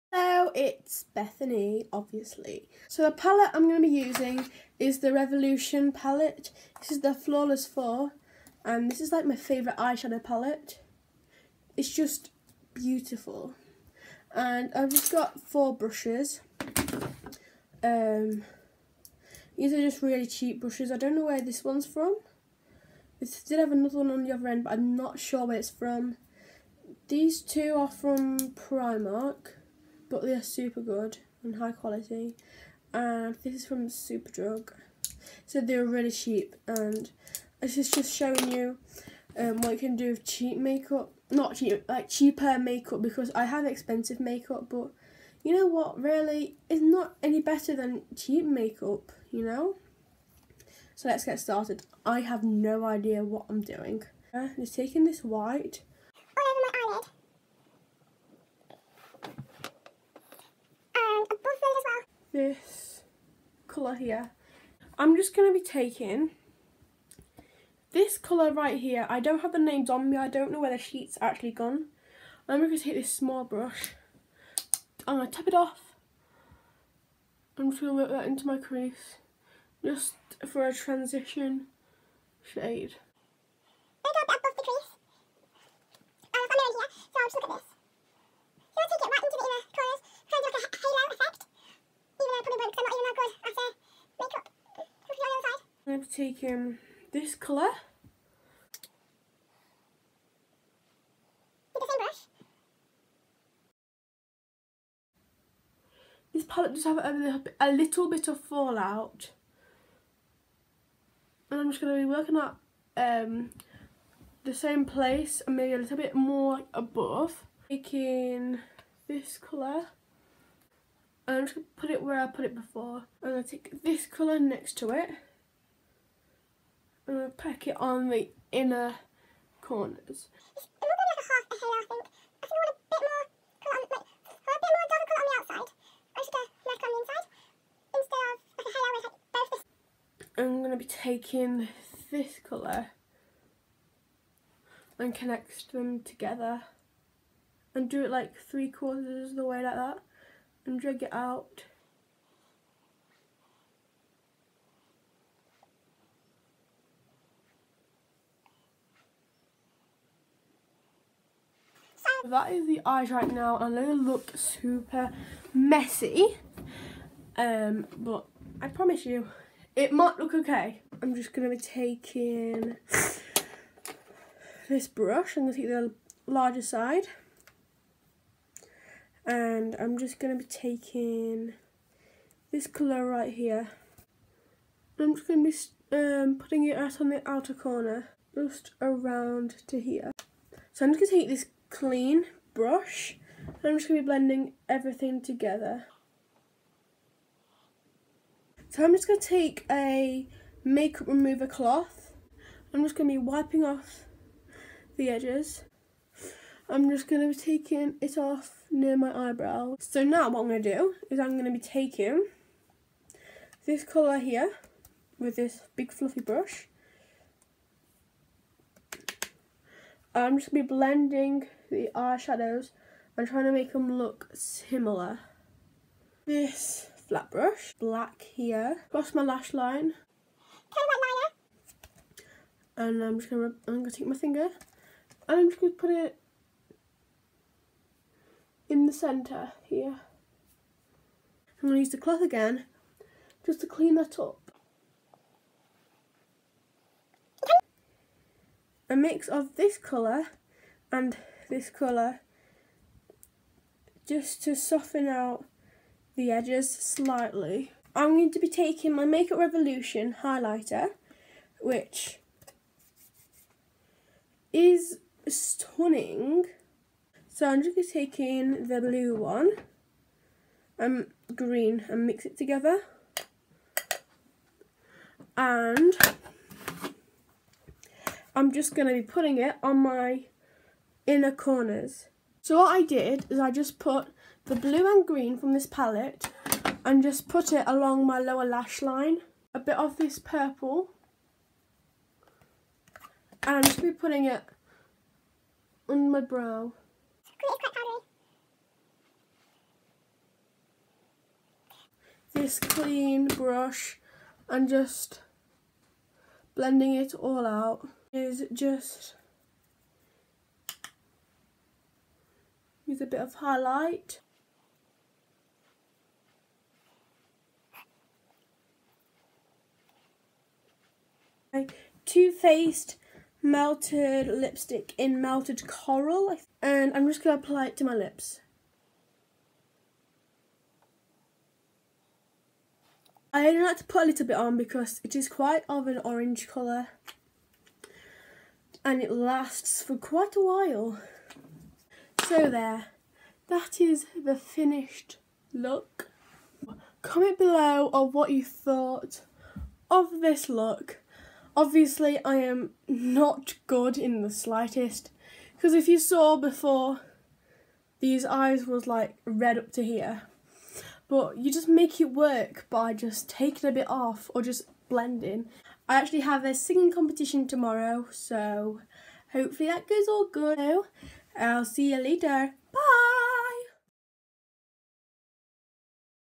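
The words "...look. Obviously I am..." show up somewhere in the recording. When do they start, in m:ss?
5:50.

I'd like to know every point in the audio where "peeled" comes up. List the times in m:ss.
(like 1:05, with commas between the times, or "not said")
not said.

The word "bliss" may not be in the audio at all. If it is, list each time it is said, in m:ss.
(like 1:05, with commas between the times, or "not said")
not said.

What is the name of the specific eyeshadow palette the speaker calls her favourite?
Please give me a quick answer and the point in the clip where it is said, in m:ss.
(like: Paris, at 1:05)
Flawless 4, at 0:07.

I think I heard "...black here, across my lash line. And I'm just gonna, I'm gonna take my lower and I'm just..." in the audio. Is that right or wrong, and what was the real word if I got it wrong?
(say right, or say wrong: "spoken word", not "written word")
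wrong: "finger", not "lower".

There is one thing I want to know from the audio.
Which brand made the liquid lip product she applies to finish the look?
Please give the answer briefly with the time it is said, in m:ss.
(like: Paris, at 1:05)
Too Faced, at 5:22.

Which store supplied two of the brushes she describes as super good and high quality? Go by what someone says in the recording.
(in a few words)
Primark.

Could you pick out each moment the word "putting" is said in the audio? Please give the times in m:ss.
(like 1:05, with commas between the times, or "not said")
3:06, 4:39, 4:53.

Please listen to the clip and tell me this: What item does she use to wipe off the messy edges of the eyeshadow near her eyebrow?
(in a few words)
makeup remover cloth.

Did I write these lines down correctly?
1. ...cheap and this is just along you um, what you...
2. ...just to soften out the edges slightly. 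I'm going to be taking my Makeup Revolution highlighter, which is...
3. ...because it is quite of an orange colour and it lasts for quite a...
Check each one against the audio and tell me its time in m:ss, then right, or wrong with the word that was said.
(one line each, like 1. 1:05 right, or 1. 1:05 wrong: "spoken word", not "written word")
1. 0:36 wrong: "showing", not "along"
2. 4:14 right
3. 5:34 right.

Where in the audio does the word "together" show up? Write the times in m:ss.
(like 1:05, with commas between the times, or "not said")
3:15, 4:32.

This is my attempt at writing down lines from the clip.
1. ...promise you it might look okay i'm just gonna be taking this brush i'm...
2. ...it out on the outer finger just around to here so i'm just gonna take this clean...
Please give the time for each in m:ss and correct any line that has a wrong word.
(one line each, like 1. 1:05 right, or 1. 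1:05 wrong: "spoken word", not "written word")
1. 2:48 right
2. 3:06 wrong: "corner", not "finger".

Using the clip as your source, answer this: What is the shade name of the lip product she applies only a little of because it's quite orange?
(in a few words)
melted coral.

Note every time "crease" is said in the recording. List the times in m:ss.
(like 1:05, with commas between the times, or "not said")
1:18, 1:24.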